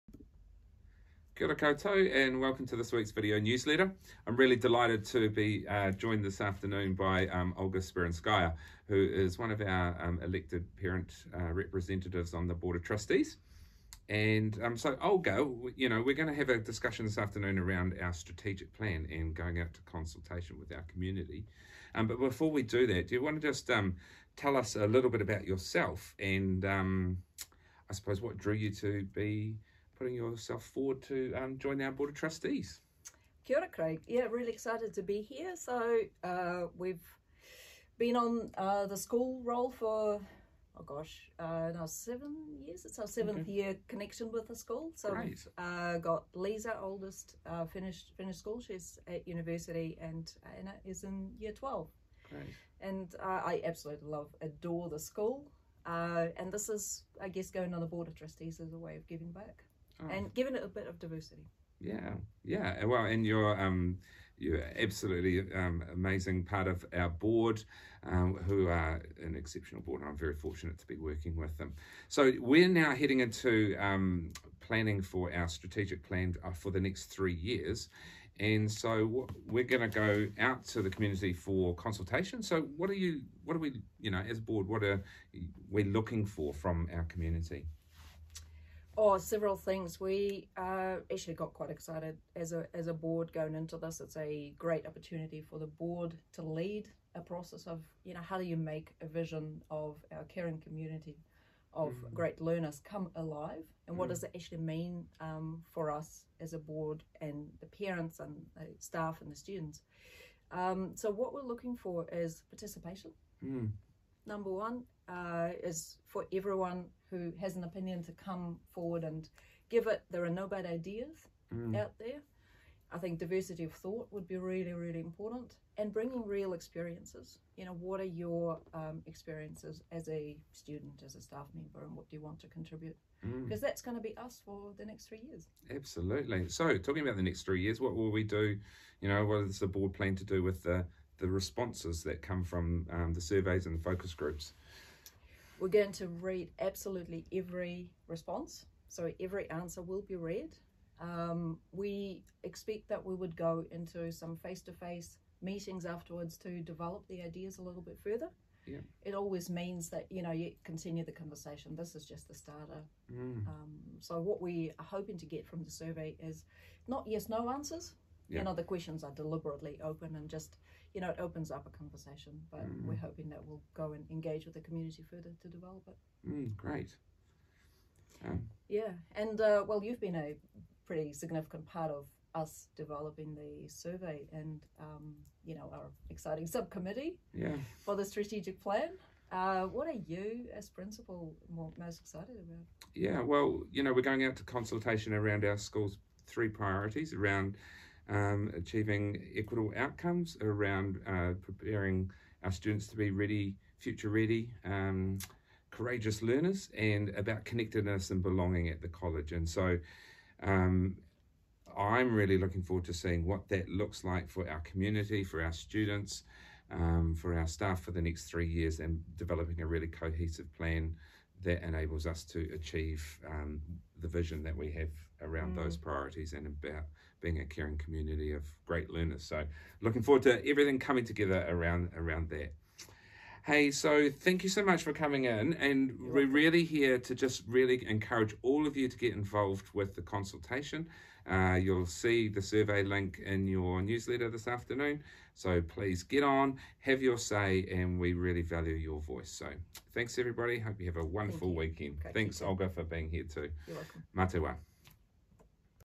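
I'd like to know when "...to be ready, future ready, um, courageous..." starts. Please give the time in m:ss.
3:22.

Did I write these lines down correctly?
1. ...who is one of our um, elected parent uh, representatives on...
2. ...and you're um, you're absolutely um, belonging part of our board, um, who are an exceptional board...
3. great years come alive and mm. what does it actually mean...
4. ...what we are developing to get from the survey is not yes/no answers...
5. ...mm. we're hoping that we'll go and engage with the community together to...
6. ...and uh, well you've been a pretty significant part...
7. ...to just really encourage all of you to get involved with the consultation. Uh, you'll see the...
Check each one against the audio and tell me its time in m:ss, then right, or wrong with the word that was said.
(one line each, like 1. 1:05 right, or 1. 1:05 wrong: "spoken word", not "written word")
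1. 0:08 right
2. 1:03 wrong: "amazing", not "belonging"
3. 1:42 wrong: "learners", not "years"
4. 2:44 wrong: "hoping", not "developing"
5. 2:52 wrong: "further", not "together"
6. 2:59 right
7. 3:56 right.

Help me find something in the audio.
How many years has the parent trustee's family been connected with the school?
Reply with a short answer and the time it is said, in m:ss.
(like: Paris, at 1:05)
7, at 0:41.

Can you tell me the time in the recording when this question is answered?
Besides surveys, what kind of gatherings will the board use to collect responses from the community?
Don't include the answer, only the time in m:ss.
2:23.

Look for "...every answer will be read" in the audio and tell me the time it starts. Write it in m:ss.
2:29.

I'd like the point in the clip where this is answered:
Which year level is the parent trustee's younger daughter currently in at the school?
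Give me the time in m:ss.
0:51.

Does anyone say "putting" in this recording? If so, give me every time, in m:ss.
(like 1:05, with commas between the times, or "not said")
0:30.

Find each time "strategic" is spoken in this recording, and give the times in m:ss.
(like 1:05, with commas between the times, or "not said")
0:18, 1:15, 3:08.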